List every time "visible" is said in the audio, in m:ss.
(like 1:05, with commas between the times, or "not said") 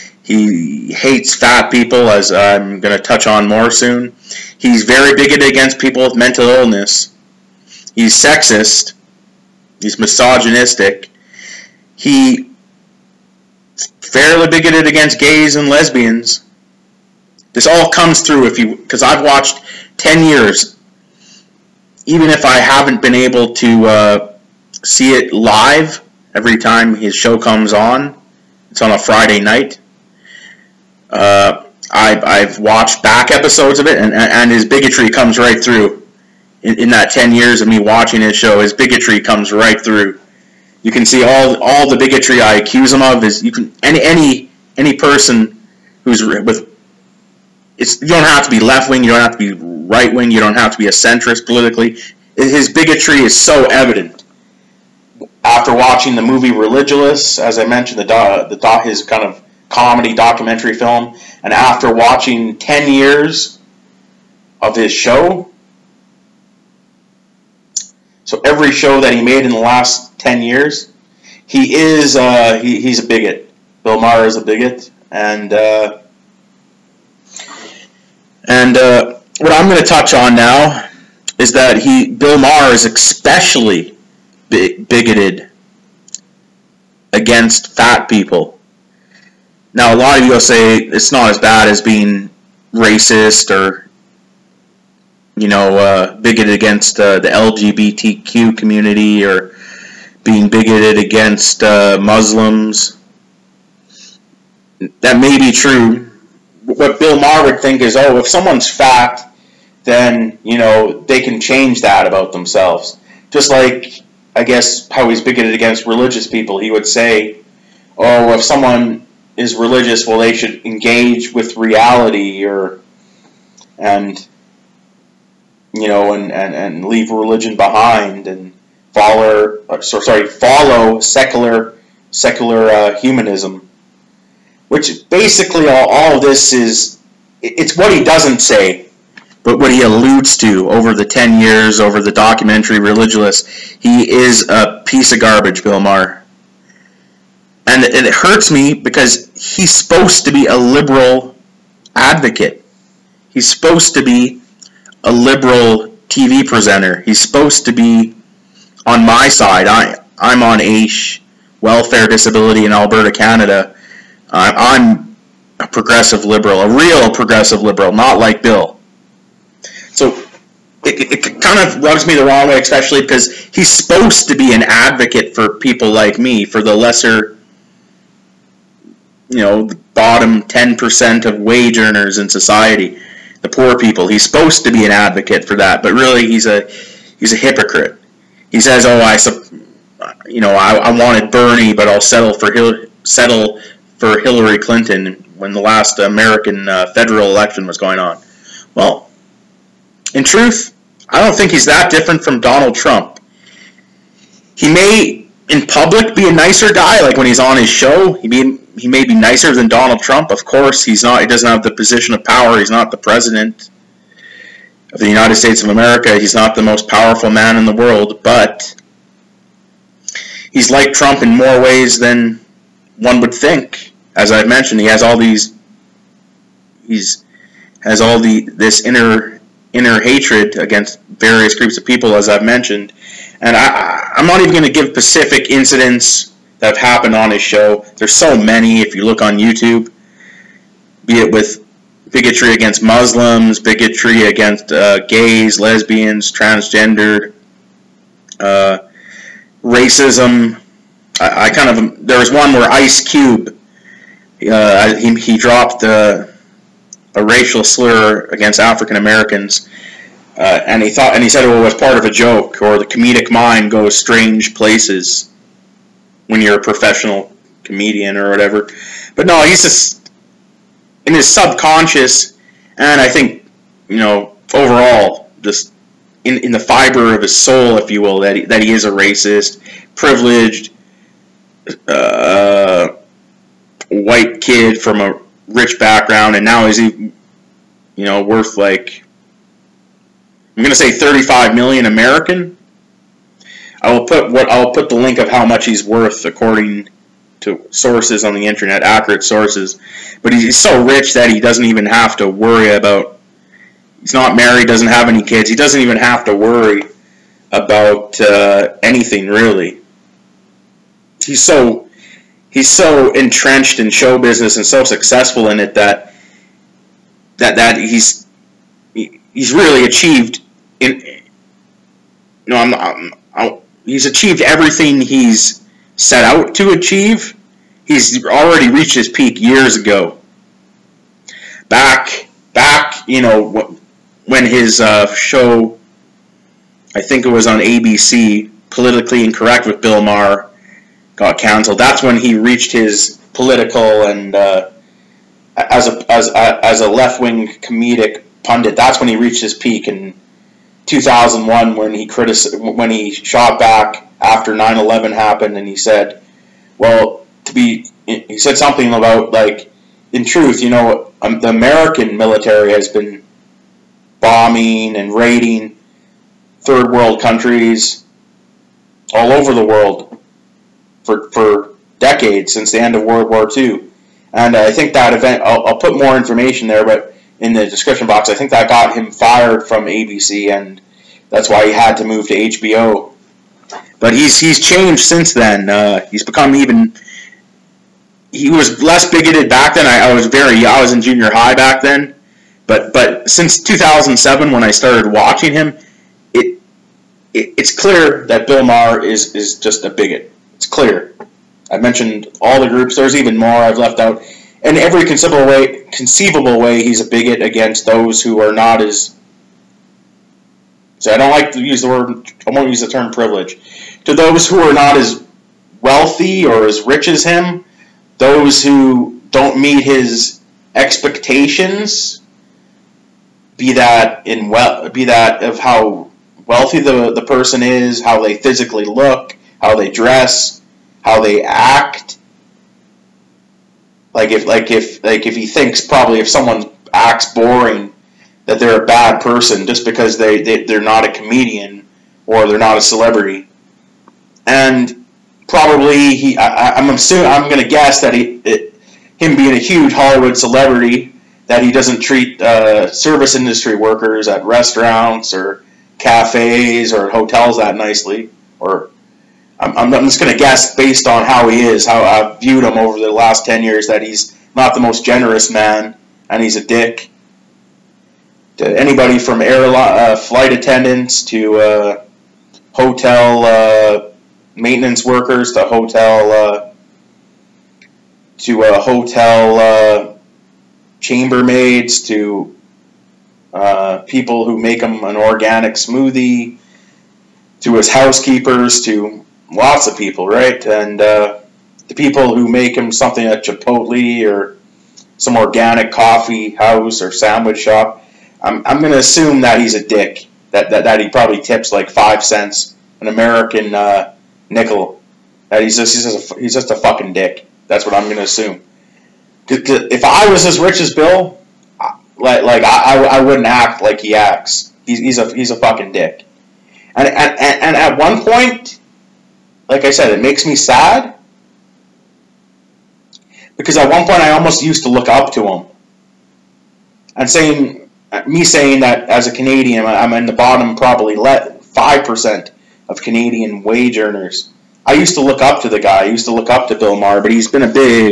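not said.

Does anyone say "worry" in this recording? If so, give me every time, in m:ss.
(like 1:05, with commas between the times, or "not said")
5:02, 5:06.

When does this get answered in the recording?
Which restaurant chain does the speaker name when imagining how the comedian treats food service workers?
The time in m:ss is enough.
8:13.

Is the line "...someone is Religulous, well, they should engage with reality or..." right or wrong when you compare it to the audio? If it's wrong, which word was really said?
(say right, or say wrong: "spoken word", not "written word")
right.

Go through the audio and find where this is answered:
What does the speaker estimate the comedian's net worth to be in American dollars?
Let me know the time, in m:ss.
4:50.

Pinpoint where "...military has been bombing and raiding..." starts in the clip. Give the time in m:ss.
6:02.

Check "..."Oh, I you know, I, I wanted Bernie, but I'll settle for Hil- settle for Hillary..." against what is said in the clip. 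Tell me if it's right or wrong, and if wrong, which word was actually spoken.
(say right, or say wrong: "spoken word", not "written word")
right.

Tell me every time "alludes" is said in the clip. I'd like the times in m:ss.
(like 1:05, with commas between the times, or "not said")
2:19.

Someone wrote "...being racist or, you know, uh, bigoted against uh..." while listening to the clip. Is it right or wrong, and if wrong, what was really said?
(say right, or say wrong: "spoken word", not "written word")
right.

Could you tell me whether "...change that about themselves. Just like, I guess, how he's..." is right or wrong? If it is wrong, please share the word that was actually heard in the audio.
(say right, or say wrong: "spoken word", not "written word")
right.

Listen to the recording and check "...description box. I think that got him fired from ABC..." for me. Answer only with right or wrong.
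right.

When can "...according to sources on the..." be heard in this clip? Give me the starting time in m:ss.
4:56.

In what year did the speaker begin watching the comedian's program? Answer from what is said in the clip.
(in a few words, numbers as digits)
2007.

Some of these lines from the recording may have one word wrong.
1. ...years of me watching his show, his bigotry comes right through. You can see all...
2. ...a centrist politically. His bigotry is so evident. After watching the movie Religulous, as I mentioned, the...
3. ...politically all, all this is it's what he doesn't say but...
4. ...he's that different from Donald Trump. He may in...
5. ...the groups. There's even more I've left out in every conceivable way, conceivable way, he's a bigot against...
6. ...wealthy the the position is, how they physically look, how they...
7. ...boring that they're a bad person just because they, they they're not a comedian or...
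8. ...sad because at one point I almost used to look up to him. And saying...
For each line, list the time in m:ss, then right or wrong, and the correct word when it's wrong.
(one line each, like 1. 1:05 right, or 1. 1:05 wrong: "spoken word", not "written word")
1. 0:37 right
2. 0:50 right
3. 2:15 wrong: "basically", not "politically"
4. 3:21 right
5. 6:42 right
6. 7:06 wrong: "person", not "position"
7. 7:17 right
8. 8:40 right.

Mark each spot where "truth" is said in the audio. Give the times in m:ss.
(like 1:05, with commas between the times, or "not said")
3:20, 6:00.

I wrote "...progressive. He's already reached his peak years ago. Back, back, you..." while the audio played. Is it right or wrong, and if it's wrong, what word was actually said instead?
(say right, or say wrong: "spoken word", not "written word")
wrong: "achieve", not "progressive".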